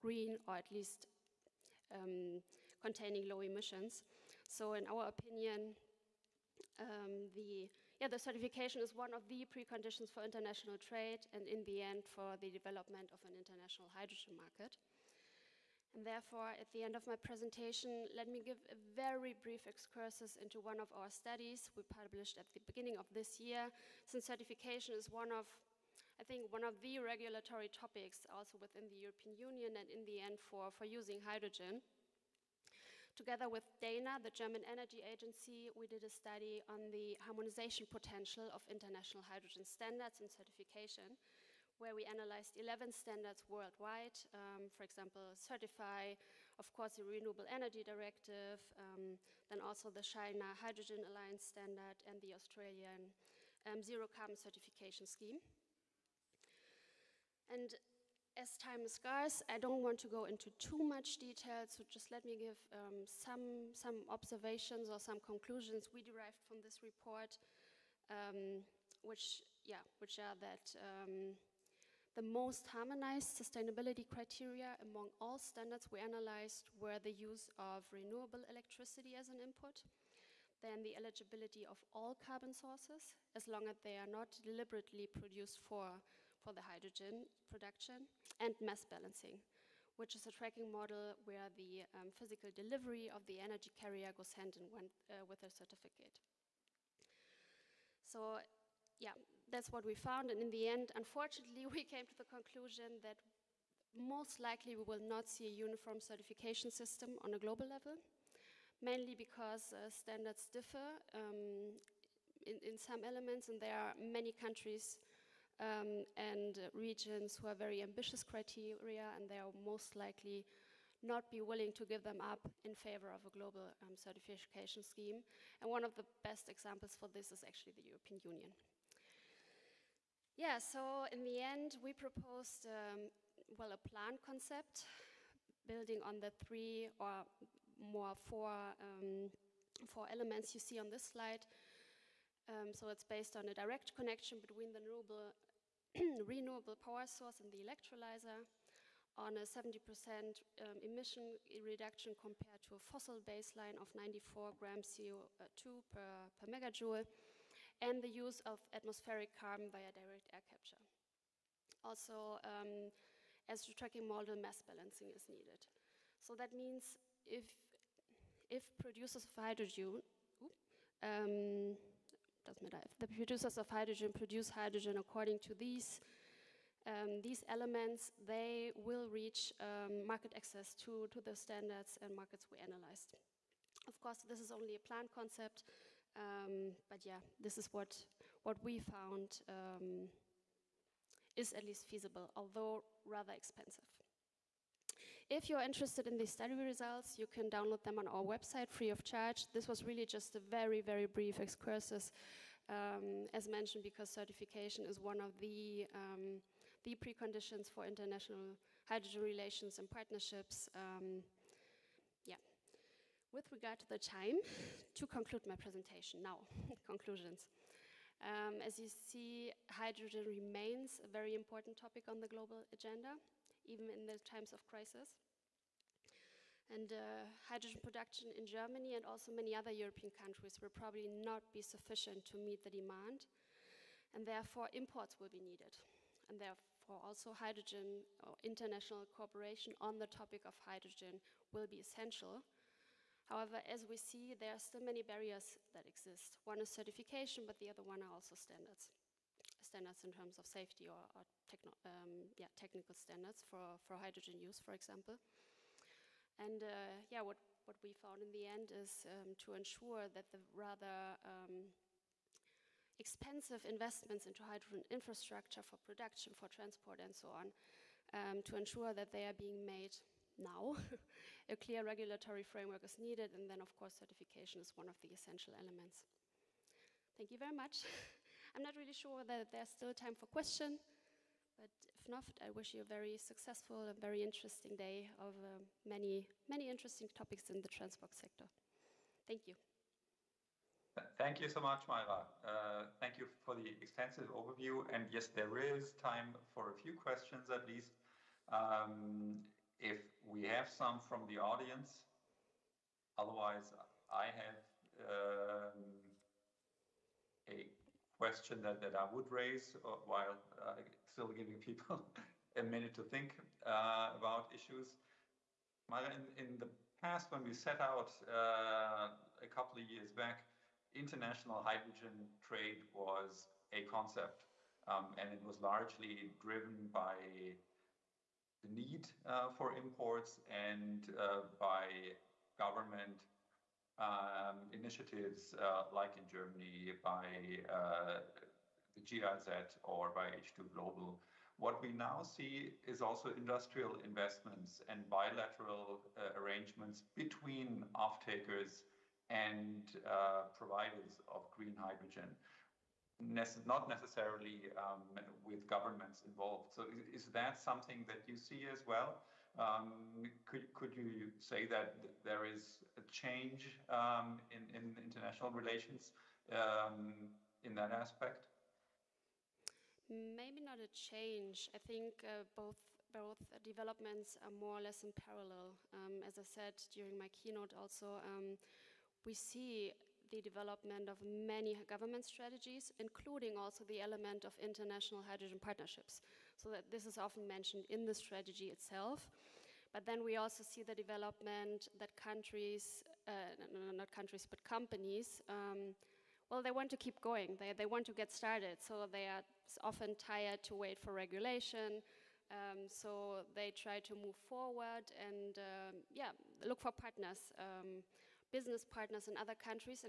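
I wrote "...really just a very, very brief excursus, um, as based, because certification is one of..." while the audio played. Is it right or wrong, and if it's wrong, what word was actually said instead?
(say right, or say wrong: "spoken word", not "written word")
wrong: "mentioned", not "based".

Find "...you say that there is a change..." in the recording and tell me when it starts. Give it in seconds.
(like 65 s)
360 s.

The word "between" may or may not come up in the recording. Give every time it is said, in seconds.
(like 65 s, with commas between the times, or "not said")
144 s, 347 s.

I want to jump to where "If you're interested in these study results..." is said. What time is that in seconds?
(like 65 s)
195 s.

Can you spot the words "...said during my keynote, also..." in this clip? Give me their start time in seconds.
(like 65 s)
376 s.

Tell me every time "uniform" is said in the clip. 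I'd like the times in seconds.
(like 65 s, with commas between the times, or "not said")
105 s.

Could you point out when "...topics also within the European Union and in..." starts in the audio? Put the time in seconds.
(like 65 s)
27 s.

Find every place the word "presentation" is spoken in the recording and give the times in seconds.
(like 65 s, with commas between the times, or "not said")
17 s, 215 s.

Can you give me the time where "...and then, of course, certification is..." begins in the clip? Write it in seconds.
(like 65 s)
273 s.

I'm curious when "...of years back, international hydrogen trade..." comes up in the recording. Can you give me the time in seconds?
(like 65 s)
319 s.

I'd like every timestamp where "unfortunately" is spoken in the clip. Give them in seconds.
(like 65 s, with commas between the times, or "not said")
100 s.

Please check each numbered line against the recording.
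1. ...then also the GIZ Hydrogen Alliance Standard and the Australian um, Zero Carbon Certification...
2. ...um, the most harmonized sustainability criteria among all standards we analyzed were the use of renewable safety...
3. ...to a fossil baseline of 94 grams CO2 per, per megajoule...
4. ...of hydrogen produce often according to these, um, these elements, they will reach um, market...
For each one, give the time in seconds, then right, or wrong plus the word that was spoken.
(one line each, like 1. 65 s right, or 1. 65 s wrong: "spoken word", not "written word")
1. 49 s wrong: "China", not "GIZ"
2. 70 s wrong: "electricity", not "safety"
3. 152 s right
4. 173 s wrong: "hydrogen", not "often".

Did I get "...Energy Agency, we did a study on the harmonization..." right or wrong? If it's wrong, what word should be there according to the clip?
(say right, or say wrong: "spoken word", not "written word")
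right.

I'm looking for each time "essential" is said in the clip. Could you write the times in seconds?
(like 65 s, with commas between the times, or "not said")
241 s, 275 s.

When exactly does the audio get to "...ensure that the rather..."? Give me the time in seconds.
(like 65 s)
259 s.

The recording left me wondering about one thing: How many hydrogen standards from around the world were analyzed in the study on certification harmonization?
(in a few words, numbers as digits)
11.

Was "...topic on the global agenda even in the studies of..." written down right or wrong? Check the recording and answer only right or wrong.
wrong.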